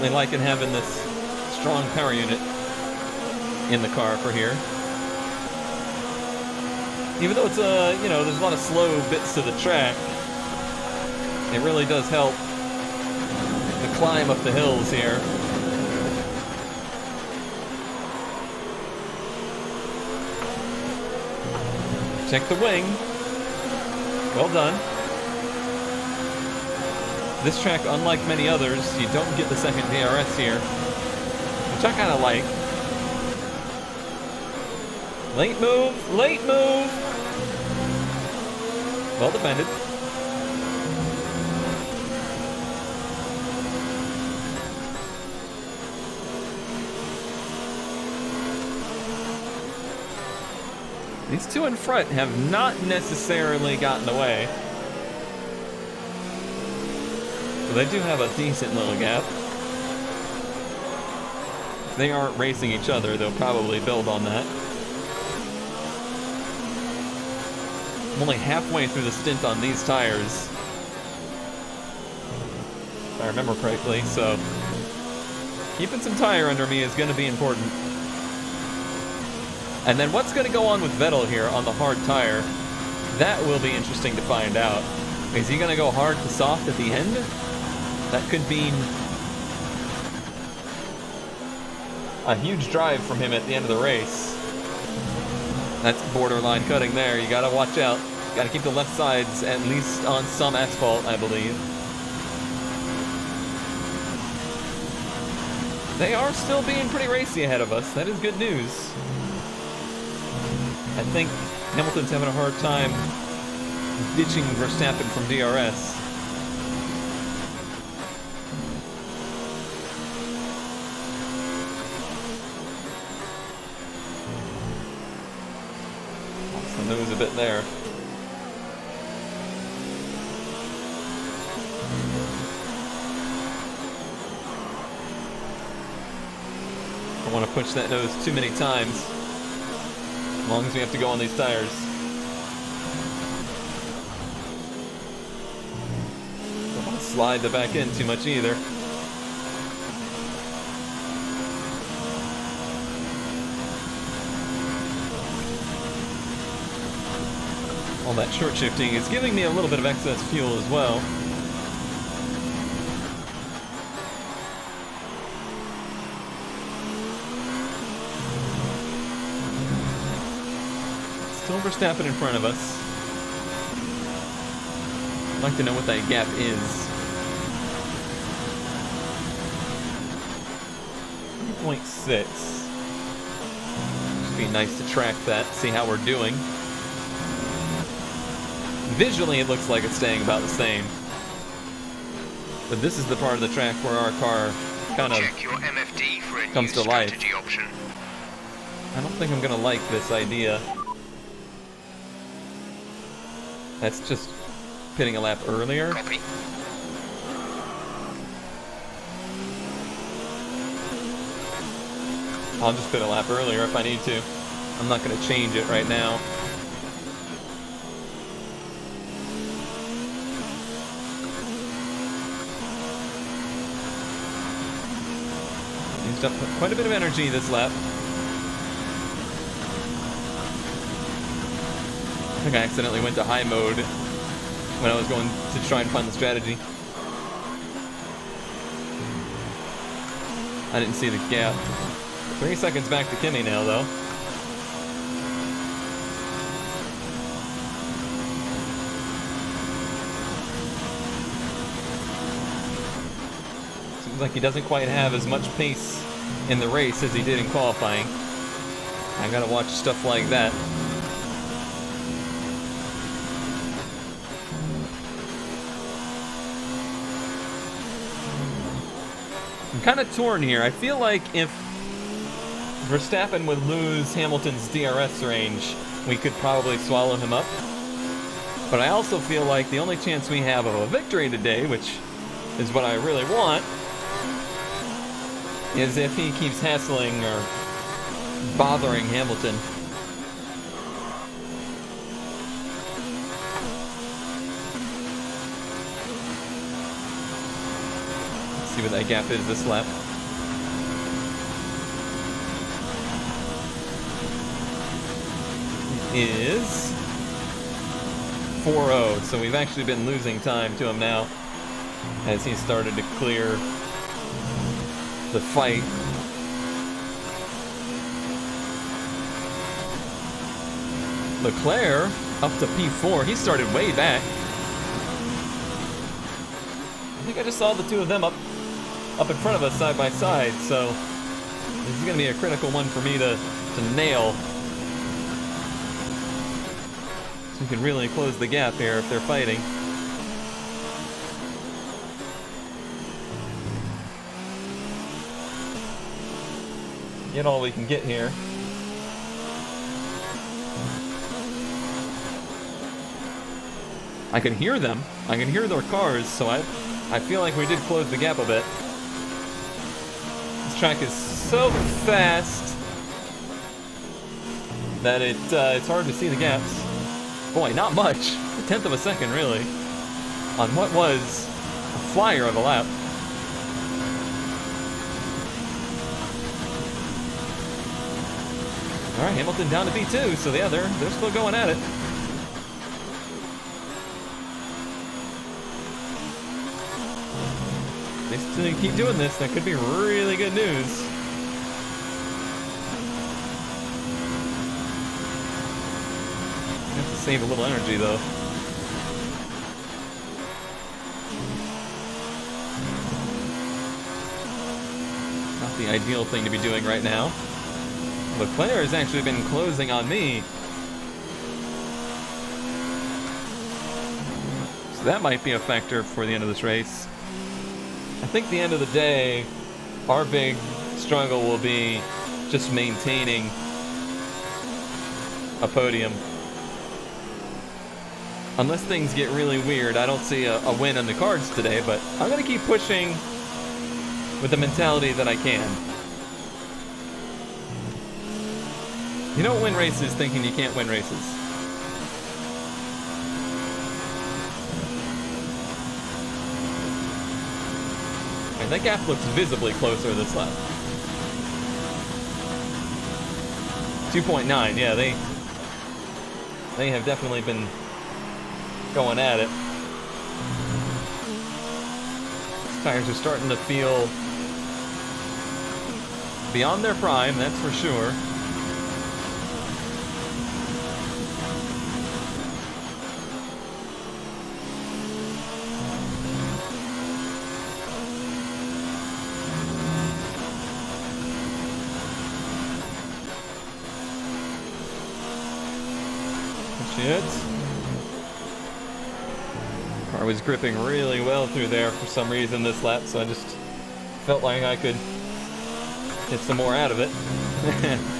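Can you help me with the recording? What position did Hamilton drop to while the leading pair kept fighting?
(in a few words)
P2.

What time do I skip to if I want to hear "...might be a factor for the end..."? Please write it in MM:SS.
06:55.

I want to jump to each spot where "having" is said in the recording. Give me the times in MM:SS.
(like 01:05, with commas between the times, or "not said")
00:00, 01:52.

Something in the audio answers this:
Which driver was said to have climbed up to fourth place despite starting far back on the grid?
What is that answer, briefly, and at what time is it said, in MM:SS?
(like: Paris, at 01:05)
Leclerc, at 05:21.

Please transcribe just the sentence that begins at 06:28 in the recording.
If they keep doing this, that could be really good news.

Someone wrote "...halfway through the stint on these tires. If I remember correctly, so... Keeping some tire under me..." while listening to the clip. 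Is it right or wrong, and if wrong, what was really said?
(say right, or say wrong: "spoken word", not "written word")
right.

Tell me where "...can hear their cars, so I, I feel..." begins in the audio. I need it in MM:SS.
05:55.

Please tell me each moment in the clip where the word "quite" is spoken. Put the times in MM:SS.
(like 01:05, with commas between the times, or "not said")
03:46, 04:14.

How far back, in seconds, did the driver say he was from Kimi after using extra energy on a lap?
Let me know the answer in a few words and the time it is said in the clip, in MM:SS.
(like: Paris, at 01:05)
3, at 04:02.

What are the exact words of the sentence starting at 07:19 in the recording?
You don't win races thinking you can't win races.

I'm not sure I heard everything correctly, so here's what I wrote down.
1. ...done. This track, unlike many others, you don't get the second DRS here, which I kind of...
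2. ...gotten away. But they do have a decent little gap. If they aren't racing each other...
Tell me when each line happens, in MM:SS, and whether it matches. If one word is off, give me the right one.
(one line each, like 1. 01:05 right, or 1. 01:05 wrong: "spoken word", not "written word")
1. 00:24 right
2. 00:53 right.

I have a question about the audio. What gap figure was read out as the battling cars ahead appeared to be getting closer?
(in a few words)
2.9.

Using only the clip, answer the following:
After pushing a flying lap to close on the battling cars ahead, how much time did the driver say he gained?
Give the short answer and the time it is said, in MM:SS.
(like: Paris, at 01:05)
A tenth of a second, at 06:08.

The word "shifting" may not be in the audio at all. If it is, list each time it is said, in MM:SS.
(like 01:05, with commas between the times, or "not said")
02:38.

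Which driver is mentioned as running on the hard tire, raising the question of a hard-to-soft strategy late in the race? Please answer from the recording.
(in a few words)
Vettel.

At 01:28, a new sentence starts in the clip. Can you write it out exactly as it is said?
That could mean a huge drive from him at the end of the race.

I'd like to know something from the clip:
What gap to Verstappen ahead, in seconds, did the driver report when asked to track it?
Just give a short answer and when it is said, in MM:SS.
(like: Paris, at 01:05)
3.6, at 03:02.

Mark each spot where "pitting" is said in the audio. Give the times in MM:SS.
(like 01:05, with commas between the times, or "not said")
03:24.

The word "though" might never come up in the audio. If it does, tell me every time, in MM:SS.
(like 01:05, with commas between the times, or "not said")
00:07, 04:03, 06:37.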